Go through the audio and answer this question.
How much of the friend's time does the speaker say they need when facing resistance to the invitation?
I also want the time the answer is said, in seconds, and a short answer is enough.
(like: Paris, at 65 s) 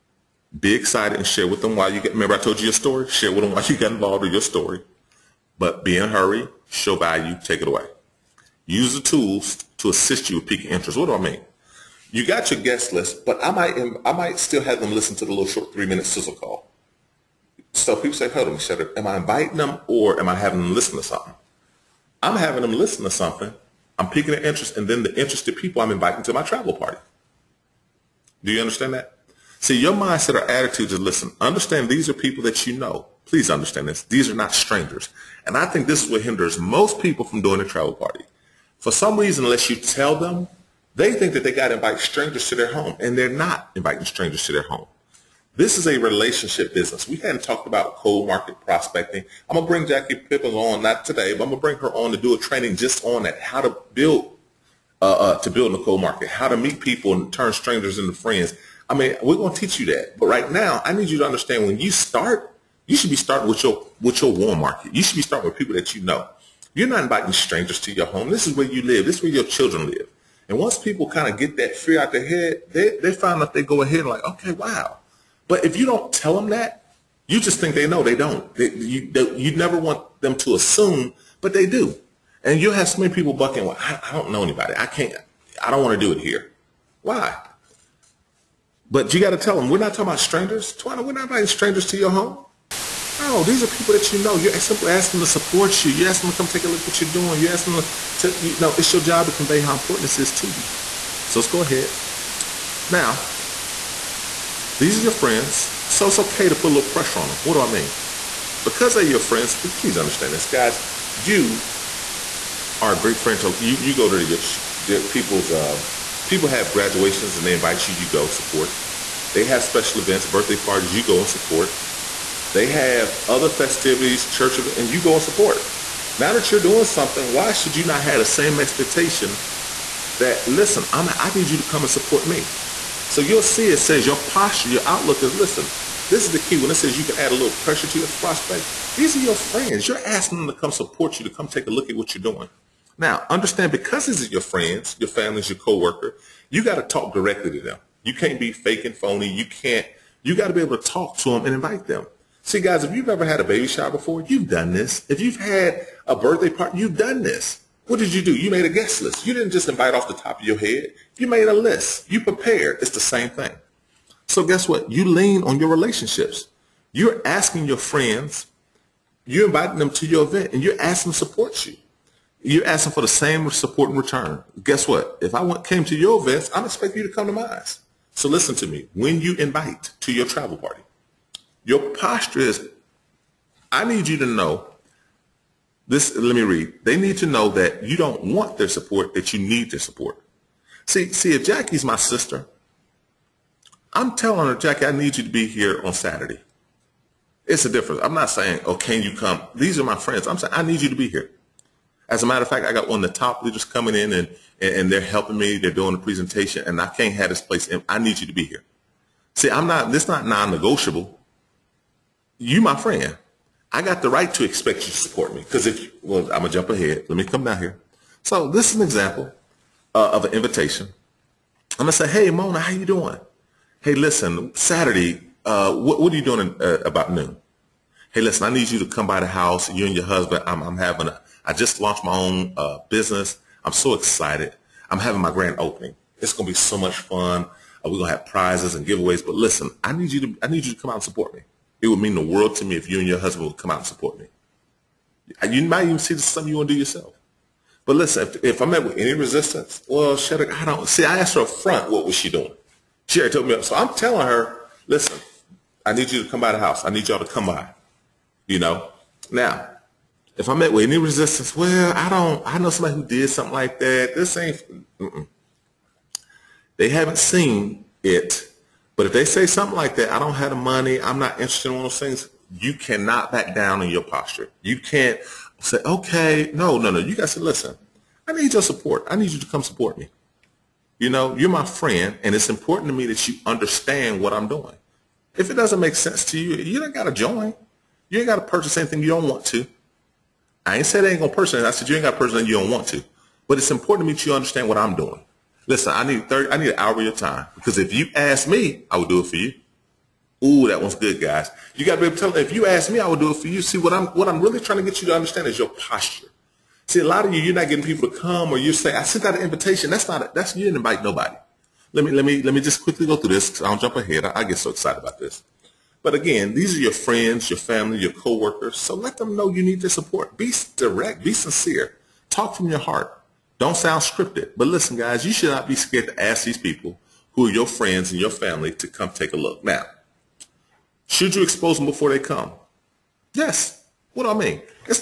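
An hour, at 296 s.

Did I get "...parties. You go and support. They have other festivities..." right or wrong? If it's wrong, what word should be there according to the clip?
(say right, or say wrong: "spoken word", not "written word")
right.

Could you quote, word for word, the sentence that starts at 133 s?
So you'll see it says your posture, your outlook is, listen, this is the key.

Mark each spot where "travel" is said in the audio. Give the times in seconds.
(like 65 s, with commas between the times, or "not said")
26 s, 37 s, 180 s.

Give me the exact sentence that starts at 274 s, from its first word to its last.
You can't say, okay, no, no, no.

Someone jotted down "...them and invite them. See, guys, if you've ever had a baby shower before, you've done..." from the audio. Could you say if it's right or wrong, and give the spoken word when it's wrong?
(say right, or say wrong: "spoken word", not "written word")
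right.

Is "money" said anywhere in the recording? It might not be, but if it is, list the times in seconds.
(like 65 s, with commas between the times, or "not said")
270 s.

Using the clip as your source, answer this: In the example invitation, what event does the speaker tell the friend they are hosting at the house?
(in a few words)
Grand opening.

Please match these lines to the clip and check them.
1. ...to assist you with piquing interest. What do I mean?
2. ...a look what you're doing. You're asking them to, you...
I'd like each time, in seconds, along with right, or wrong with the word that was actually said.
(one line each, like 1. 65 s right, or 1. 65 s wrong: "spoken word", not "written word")
1. 9 s right
2. 96 s right.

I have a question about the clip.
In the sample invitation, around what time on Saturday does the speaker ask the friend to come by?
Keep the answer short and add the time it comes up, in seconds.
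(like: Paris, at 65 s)
Noon, at 227 s.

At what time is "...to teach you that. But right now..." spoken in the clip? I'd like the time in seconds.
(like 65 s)
59 s.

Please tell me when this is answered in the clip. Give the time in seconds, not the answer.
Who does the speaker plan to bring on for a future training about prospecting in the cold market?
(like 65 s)
49 s.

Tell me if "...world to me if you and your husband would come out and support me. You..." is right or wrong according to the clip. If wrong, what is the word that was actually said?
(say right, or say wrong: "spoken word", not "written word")
right.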